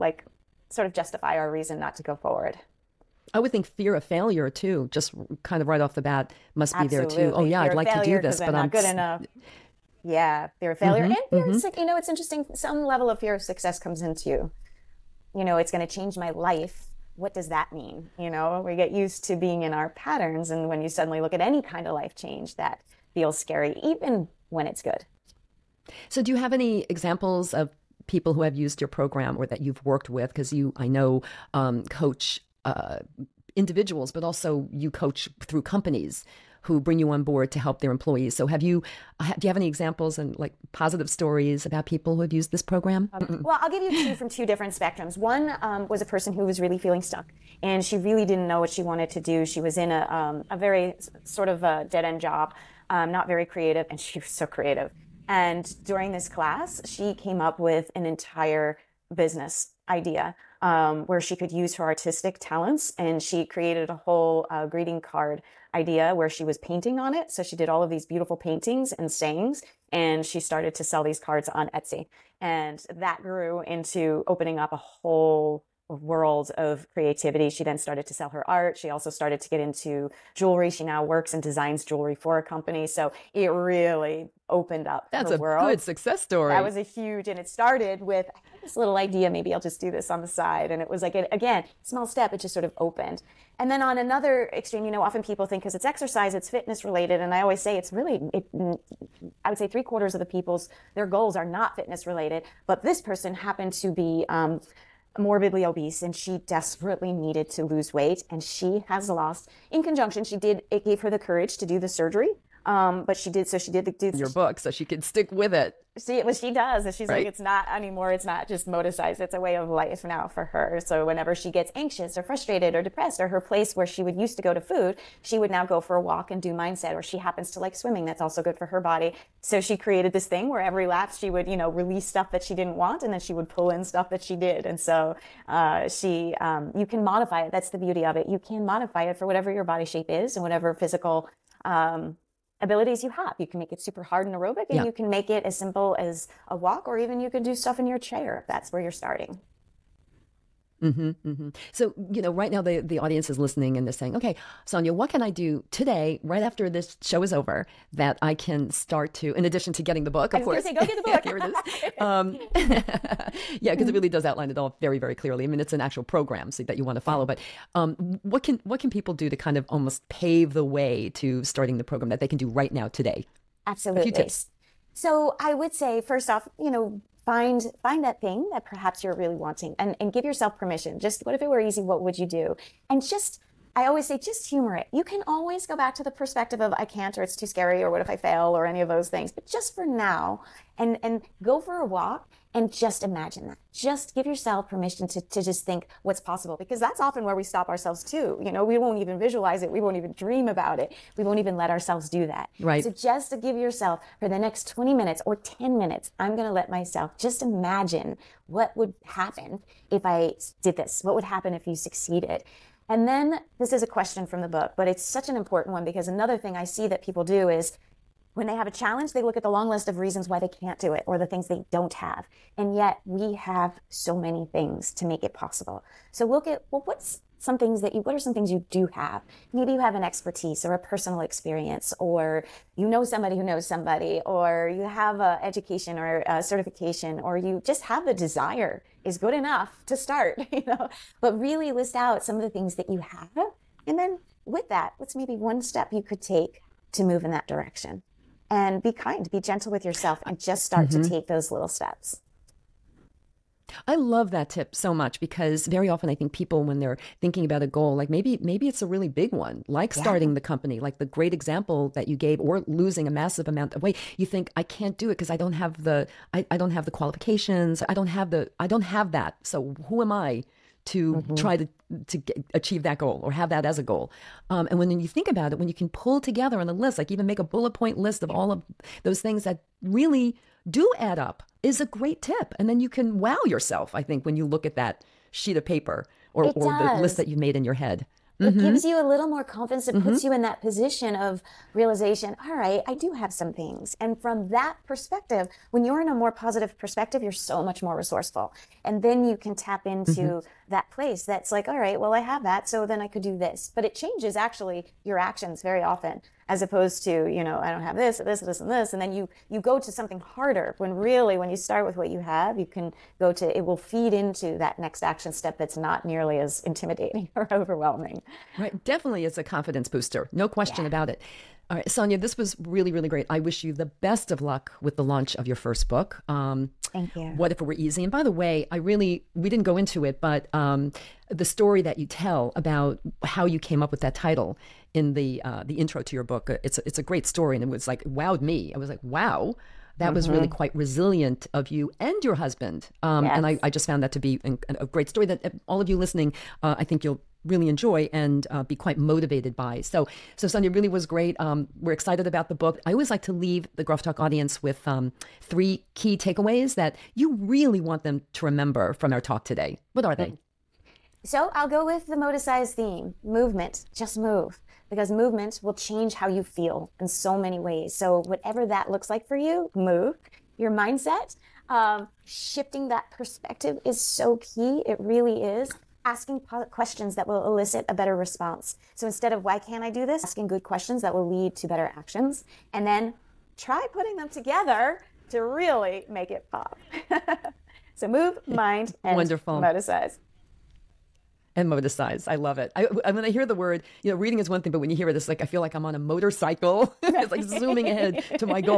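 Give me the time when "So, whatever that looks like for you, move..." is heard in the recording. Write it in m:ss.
6:07.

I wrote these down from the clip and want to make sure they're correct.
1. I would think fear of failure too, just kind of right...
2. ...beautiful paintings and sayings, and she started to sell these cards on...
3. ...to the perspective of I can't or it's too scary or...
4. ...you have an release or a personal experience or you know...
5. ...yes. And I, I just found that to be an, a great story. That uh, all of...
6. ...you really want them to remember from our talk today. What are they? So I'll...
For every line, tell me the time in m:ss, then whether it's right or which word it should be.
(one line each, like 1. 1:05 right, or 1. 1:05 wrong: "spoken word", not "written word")
1. 0:03 right
2. 1:08 right
3. 3:05 right
4. 3:49 wrong: "expertise", not "release"
5. 5:43 right
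6. 5:57 right.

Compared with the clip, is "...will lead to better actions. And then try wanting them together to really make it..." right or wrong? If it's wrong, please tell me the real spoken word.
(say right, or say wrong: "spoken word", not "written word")
wrong: "putting", not "wanting".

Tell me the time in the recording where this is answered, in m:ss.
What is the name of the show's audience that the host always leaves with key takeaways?
5:53.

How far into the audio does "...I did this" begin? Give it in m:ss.
3:30.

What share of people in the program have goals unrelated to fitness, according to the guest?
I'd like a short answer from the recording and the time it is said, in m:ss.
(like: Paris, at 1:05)
Three quarters, at 1:39.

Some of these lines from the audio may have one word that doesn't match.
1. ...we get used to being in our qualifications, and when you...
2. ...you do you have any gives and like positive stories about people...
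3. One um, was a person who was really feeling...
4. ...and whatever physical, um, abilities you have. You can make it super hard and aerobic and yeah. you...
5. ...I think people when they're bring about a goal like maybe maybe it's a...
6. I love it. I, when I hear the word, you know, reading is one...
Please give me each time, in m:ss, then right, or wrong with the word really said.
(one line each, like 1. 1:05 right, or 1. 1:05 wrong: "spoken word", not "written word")
1. 0:18 wrong: "patterns", not "qualifications"
2. 0:38 wrong: "examples", not "gives"
3. 0:45 right
4. 2:20 right
5. 4:16 wrong: "thinking", not "bring"
6. 6:32 right.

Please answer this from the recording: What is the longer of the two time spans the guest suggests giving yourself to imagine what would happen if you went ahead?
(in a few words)
20 minutes.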